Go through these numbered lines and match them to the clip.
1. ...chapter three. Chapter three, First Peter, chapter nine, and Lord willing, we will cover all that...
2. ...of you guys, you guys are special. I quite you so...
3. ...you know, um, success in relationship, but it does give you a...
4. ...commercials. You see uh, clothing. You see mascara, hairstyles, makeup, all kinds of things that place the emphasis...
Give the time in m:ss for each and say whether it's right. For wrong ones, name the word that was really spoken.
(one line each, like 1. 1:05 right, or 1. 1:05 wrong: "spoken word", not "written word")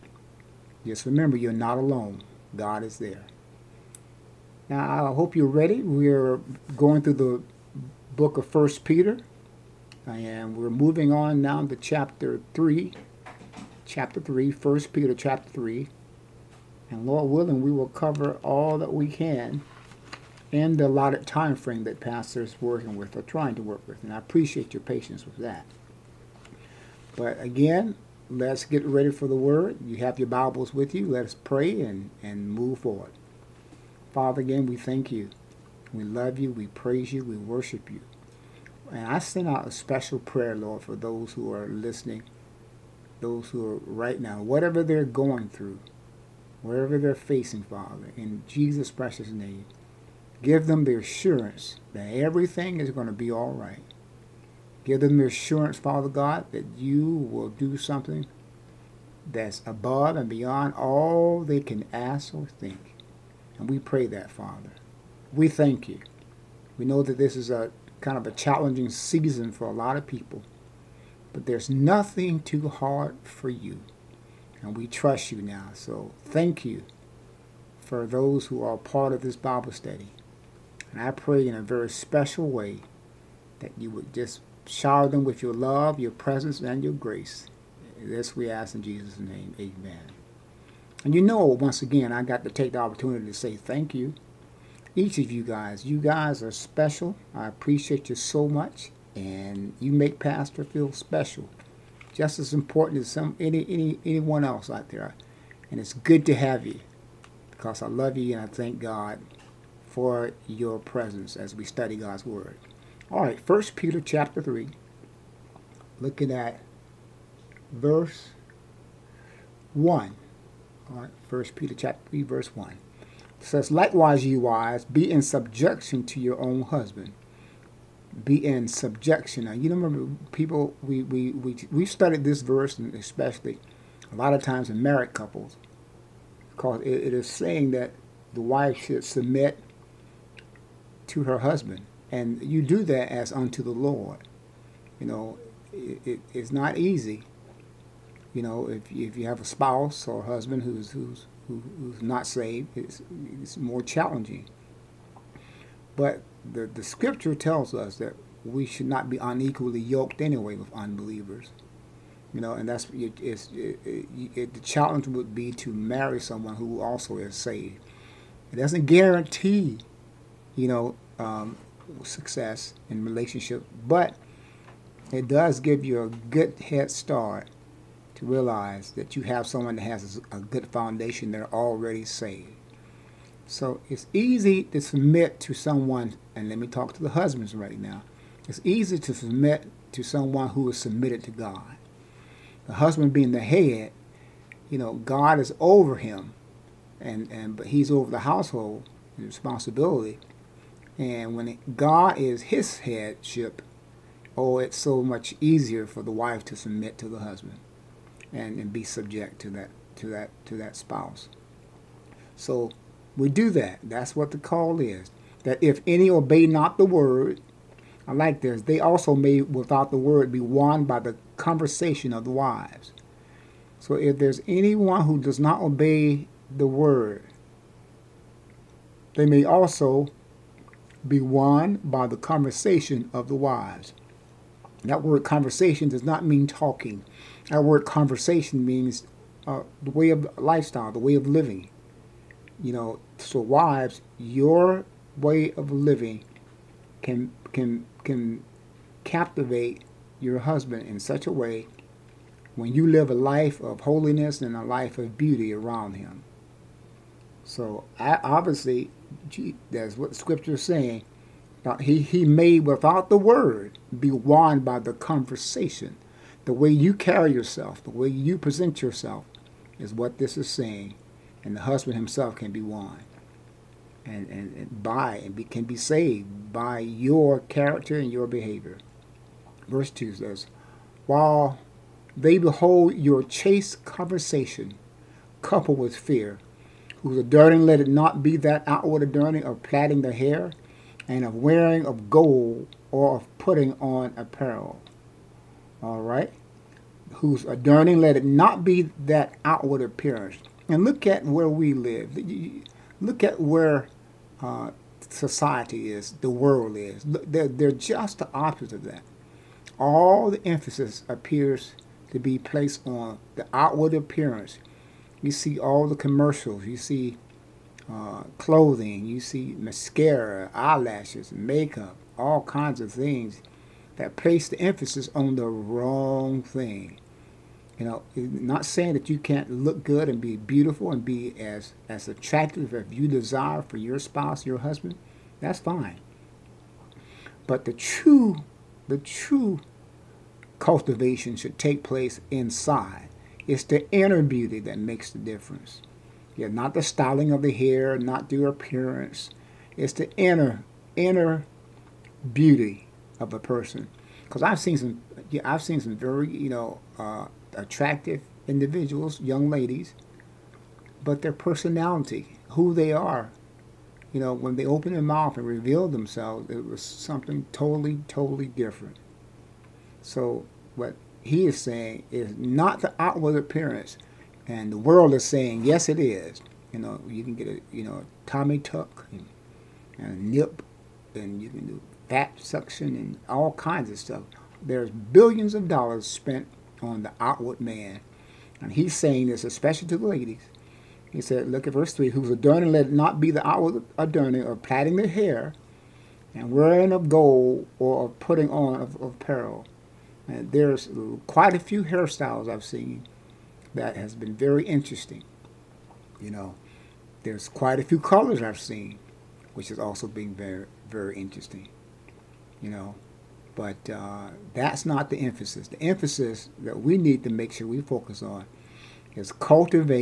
1. 0:11 wrong: "three", not "nine"
2. 1:35 wrong: "appreciate", not "quite"
3. 2:50 right
4. 5:15 wrong: "eyelashes", not "hairstyles".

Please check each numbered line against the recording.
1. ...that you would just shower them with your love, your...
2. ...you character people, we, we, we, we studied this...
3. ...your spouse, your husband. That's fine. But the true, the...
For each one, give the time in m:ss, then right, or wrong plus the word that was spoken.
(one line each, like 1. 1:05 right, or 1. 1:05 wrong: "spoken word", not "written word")
1. 1:23 right
2. 2:09 wrong: "remember", not "character"
3. 5:33 right.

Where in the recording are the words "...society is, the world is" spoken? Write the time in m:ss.
5:05.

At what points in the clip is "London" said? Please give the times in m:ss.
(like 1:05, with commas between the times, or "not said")
not said.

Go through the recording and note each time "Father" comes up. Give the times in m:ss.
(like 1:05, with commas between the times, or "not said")
0:34, 0:47, 0:55, 1:04.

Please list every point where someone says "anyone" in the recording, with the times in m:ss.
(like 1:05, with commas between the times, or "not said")
1:44, 3:44.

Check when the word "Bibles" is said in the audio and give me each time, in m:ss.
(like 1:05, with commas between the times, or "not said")
0:30, 1:19.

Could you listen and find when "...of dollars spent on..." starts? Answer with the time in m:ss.
6:25.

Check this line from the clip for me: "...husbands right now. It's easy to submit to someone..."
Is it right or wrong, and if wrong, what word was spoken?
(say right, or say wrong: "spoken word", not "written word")
right.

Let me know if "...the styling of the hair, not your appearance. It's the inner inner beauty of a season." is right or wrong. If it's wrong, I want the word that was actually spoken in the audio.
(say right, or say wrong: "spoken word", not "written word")
wrong: "person", not "season".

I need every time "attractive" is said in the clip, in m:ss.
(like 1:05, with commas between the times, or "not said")
5:32, 5:57.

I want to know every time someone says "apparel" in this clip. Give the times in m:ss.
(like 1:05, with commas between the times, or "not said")
4:54, 6:39.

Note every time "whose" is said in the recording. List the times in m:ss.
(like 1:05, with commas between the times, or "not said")
4:47, 4:57, 6:32.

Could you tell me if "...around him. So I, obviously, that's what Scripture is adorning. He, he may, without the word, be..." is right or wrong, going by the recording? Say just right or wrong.
wrong.